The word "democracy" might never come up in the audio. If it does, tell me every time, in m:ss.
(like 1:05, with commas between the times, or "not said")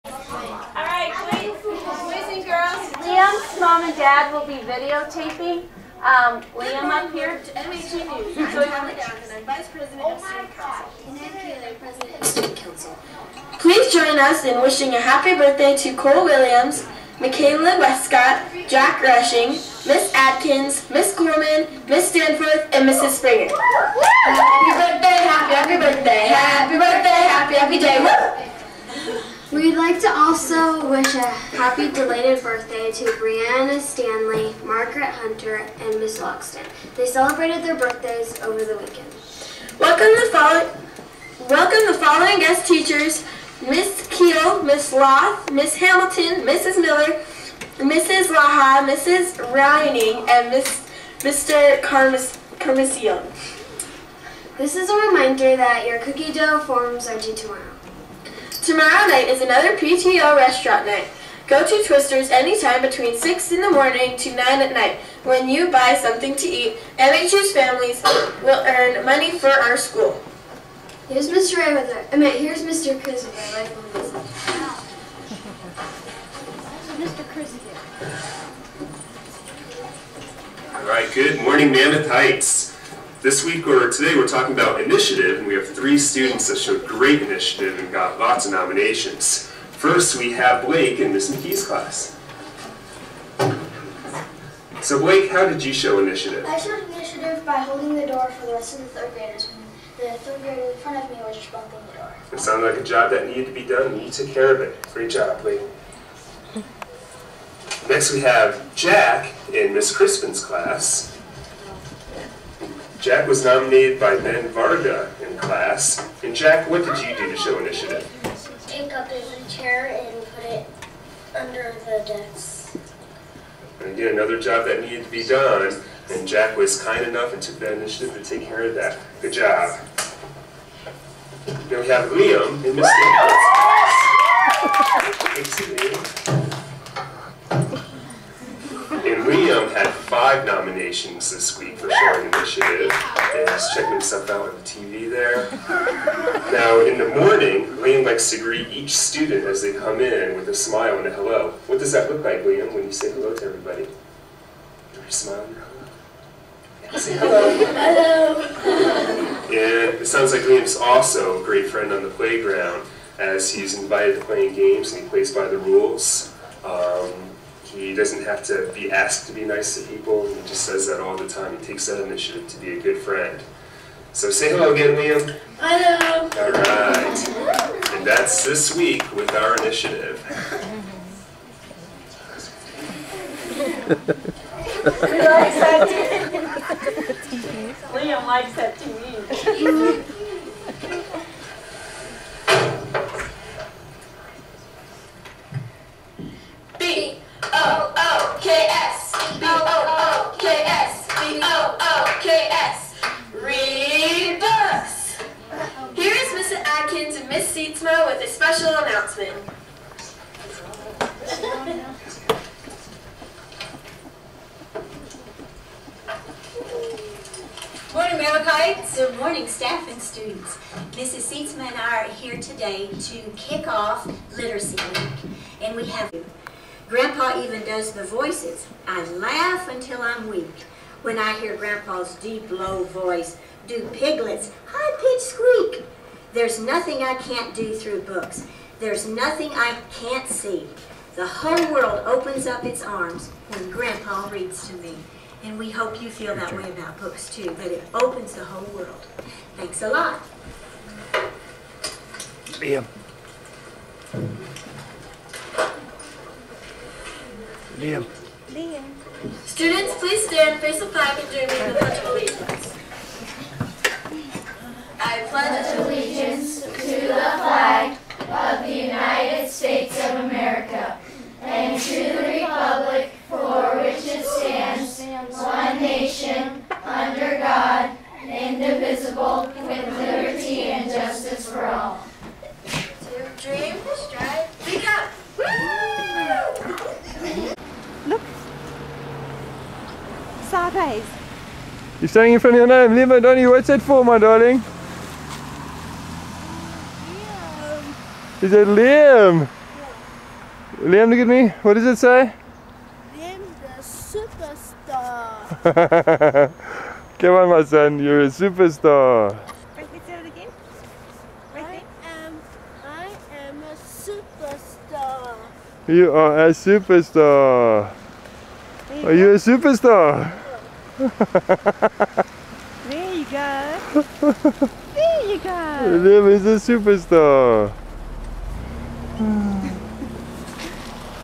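not said.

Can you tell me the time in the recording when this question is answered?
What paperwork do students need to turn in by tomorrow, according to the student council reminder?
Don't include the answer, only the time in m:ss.
0:55.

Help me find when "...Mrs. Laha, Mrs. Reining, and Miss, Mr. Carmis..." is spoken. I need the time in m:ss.
0:47.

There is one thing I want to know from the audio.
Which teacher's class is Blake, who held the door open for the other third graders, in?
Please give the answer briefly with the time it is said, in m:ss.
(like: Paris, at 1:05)
Miss McKee's, at 1:31.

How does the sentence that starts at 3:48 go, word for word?
I laugh until I'm weak when I hear Grandpa's deep, low voice do piglets, high-pitched squeak.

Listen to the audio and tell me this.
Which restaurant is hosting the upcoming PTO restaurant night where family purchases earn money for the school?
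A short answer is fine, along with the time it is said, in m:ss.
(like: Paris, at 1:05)
Twister's, at 1:01.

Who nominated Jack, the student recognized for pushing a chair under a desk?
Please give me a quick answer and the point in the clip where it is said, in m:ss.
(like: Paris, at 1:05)
Ben Varga, at 1:54.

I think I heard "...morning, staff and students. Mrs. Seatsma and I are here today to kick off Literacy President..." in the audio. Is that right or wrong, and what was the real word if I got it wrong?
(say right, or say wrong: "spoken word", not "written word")
wrong: "Week", not "President".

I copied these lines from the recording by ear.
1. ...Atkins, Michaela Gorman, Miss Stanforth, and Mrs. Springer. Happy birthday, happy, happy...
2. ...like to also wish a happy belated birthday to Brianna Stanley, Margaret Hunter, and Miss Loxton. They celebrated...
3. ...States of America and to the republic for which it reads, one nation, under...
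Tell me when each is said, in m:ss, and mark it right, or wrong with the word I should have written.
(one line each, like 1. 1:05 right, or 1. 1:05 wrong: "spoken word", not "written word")
1. 0:20 wrong: "Miss", not "Michaela"
2. 0:29 right
3. 4:29 wrong: "stands", not "reads".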